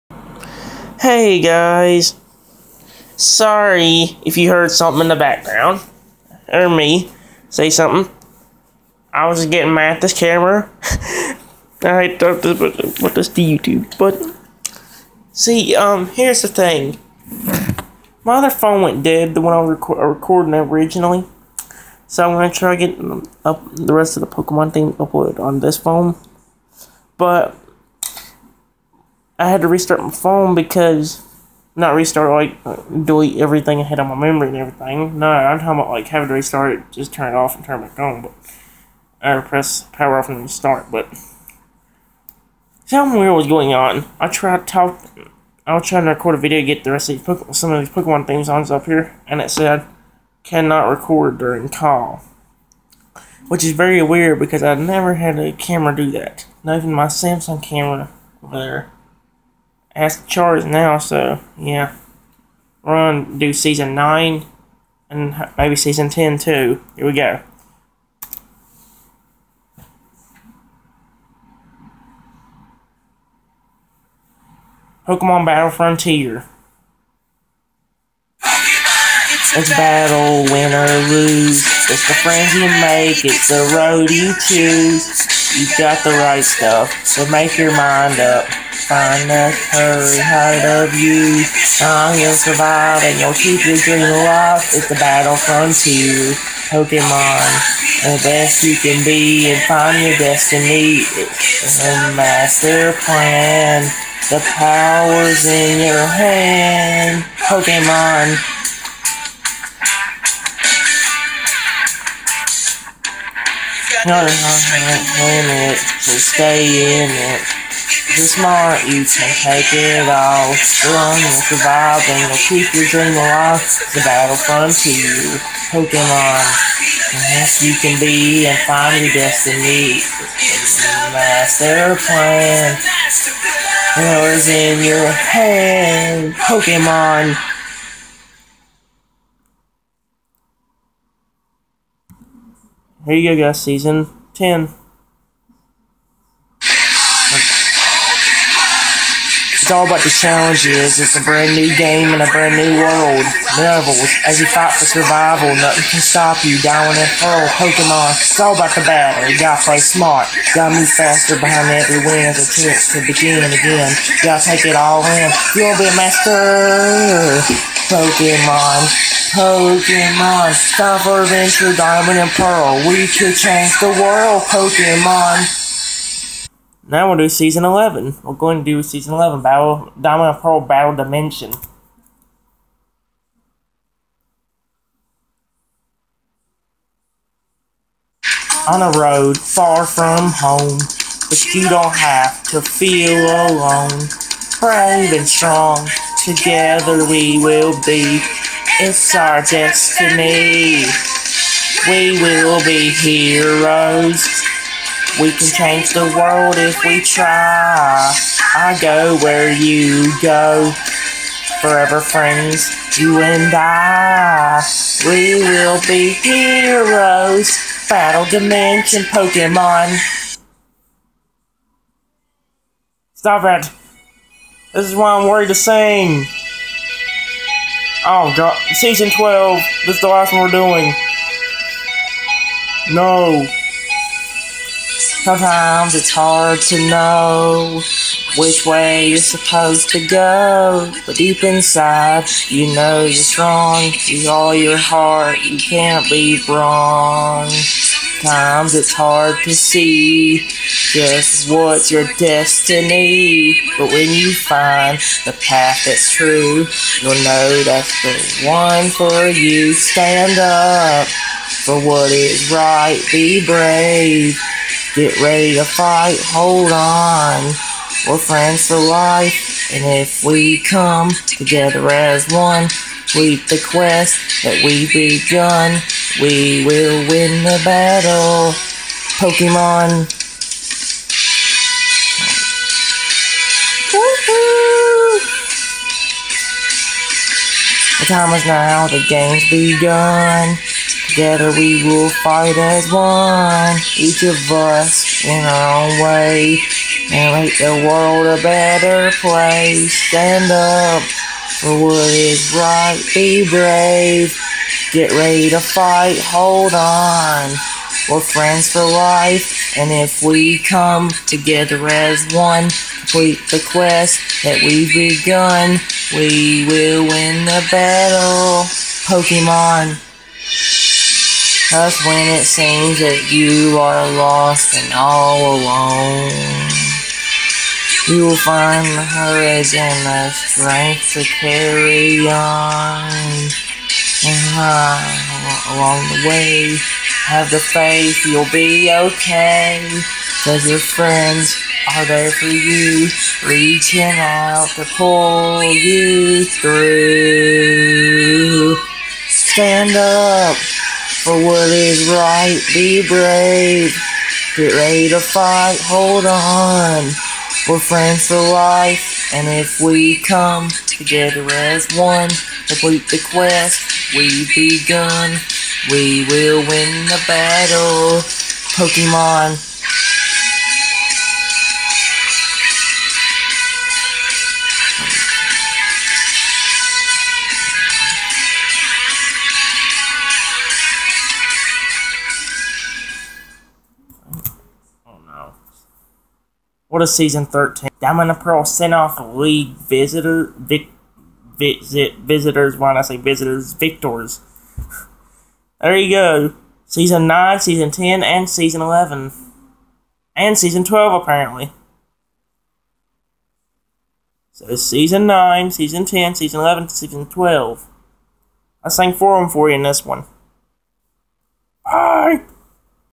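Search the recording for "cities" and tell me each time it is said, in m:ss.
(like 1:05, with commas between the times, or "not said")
not said.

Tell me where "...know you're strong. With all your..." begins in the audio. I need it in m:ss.
4:02.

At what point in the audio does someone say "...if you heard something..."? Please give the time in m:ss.
0:04.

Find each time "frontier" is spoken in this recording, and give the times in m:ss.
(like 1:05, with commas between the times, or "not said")
1:15, 1:35.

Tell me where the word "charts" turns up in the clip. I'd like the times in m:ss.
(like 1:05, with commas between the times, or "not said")
1:00.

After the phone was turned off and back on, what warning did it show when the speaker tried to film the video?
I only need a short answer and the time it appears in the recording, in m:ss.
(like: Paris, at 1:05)
Cannot record during call, at 0:50.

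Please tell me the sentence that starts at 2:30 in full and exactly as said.
It's a brand new game in a brand new world.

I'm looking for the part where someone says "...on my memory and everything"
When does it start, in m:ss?
0:33.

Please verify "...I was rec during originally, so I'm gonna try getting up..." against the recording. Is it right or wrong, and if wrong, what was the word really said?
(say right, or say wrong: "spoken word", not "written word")
wrong: "recording", not "during".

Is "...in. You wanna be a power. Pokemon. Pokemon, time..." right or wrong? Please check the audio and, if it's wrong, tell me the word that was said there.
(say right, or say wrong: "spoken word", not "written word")
wrong: "master", not "power".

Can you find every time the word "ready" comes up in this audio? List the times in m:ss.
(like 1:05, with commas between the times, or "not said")
4:25, 5:05, 5:54.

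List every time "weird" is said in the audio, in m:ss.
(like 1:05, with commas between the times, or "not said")
0:43, 0:54.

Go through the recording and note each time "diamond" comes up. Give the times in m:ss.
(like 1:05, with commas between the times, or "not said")
2:51, 2:59, 6:28.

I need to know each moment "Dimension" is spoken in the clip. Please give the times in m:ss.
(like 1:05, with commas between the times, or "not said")
3:00, 3:38.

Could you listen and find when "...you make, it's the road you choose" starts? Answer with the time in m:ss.
1:22.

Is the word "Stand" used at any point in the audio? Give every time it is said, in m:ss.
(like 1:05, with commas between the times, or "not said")
4:19, 5:00, 5:49.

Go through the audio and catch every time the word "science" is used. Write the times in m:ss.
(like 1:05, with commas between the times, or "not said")
not said.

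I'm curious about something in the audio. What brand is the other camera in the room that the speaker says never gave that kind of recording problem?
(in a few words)
Samsung.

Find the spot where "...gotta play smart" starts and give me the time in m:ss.
2:39.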